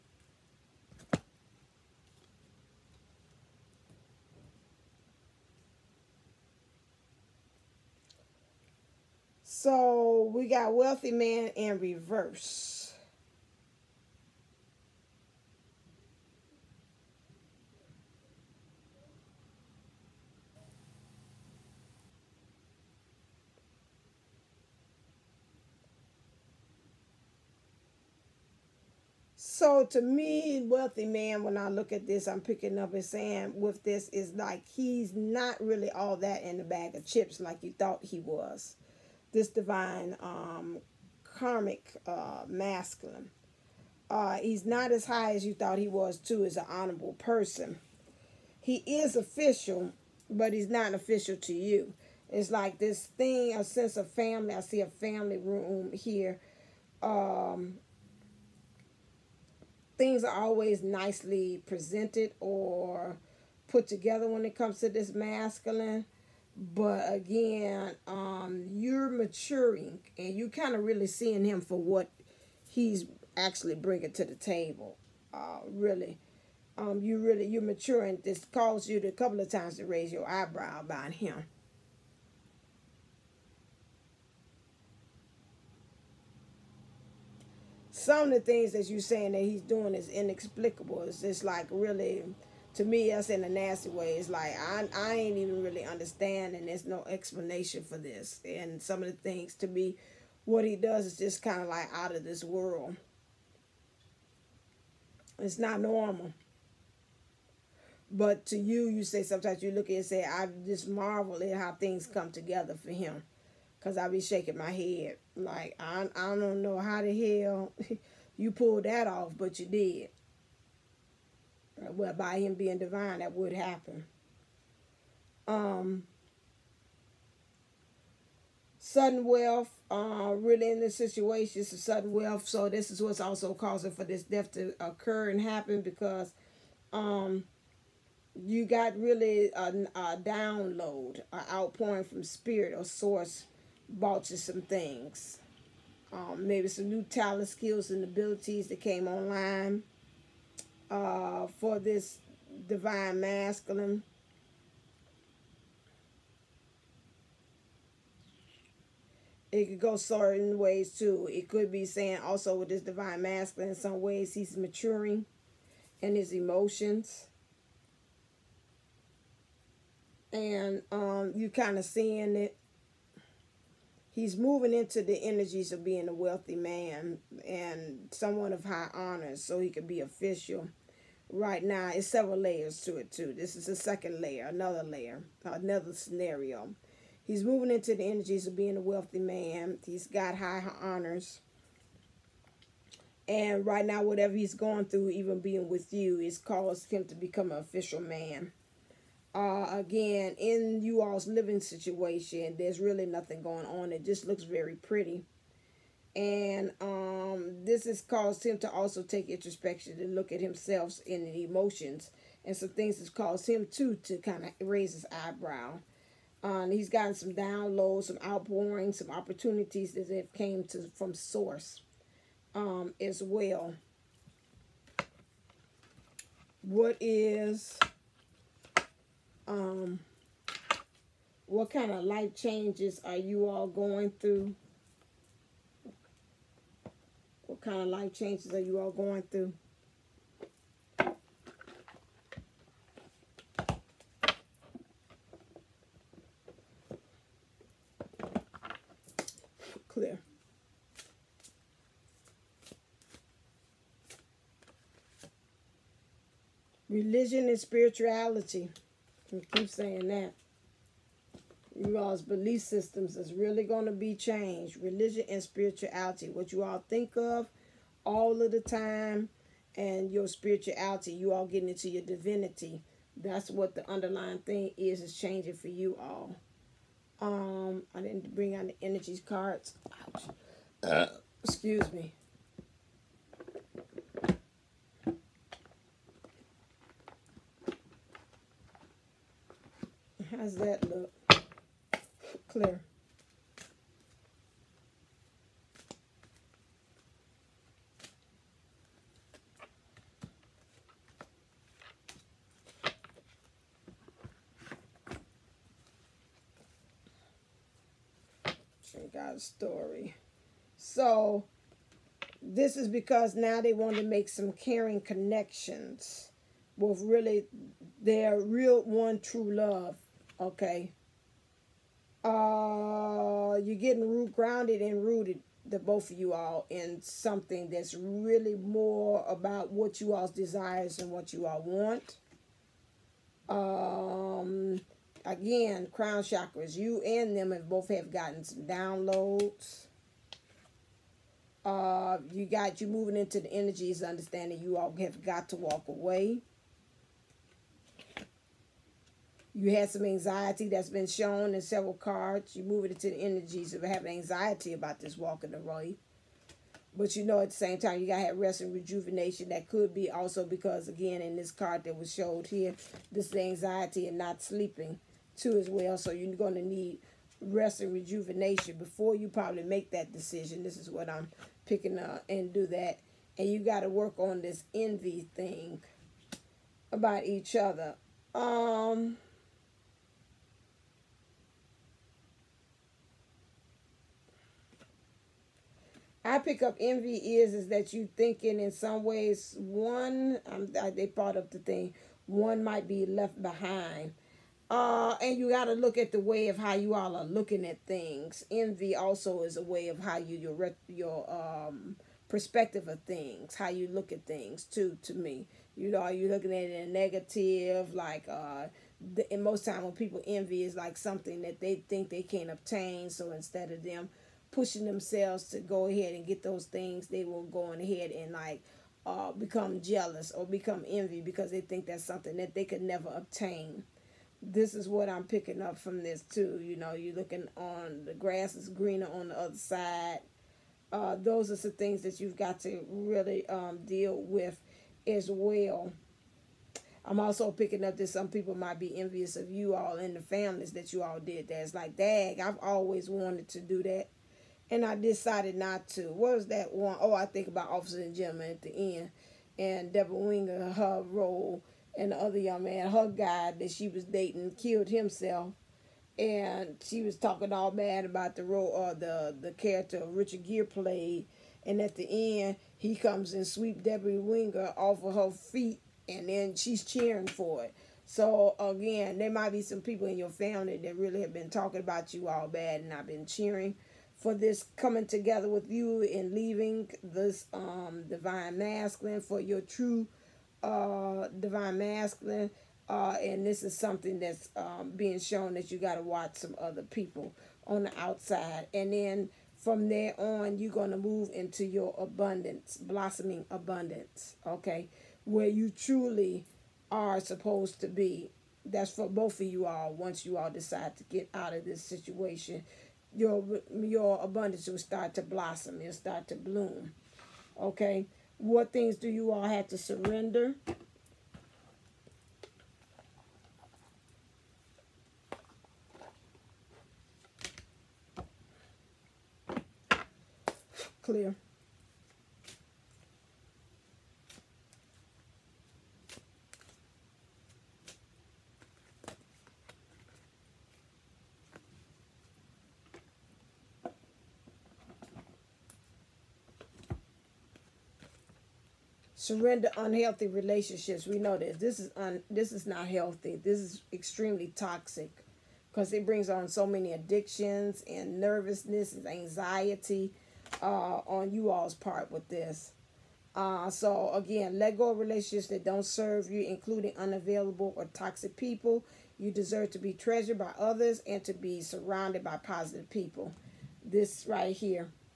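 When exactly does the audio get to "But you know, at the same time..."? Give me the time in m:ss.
5:56.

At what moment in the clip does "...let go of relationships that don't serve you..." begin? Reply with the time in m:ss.
9:14.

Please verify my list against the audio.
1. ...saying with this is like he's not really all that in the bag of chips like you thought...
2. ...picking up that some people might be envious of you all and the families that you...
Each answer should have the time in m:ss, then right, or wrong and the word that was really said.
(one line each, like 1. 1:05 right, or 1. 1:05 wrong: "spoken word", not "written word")
1. 0:33 right
2. 7:17 right.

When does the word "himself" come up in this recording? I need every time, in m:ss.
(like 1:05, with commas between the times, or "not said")
3:30, 7:34.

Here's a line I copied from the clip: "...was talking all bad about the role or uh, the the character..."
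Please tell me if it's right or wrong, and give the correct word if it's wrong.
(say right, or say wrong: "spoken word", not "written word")
right.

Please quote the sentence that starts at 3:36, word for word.
Um, he's gotten some downloads, some outpourings, some opportunities that have came to from source um, as well.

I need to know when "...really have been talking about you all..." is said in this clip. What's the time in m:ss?
7:50.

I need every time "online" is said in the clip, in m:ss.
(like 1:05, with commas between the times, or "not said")
2:29.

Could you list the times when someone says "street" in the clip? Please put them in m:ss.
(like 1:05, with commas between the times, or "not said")
not said.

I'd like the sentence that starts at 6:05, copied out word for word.
So you're going to need rest and rejuvenation before you probably make that decision.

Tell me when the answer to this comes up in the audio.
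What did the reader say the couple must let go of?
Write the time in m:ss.
8:59.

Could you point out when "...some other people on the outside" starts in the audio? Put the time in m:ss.
8:06.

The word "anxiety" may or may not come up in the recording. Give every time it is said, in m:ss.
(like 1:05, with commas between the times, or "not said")
5:50, 5:54, 6:03, 9:09.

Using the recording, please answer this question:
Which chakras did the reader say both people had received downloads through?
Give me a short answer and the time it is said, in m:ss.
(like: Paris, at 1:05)
Crown chakras, at 5:35.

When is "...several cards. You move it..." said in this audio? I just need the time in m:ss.
5:51.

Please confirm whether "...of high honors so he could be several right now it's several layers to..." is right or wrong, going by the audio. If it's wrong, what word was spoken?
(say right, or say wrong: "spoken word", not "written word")
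wrong: "official", not "several".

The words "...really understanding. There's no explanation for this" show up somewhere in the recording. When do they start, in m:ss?
1:35.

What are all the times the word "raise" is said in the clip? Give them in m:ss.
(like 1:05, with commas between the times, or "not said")
1:19, 3:34.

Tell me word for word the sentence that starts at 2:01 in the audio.
Uh, well, by him being divine, that would happen.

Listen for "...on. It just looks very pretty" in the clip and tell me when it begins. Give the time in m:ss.
3:23.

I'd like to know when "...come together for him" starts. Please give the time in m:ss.
1:52.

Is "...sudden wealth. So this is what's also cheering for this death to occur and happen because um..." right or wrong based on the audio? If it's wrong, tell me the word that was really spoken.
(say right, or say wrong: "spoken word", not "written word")
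wrong: "causing", not "cheering".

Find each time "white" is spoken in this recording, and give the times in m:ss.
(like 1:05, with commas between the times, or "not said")
not said.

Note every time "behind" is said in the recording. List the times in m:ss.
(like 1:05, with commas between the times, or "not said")
6:33.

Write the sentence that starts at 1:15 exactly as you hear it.
Uh, really, um, you really you're maturing.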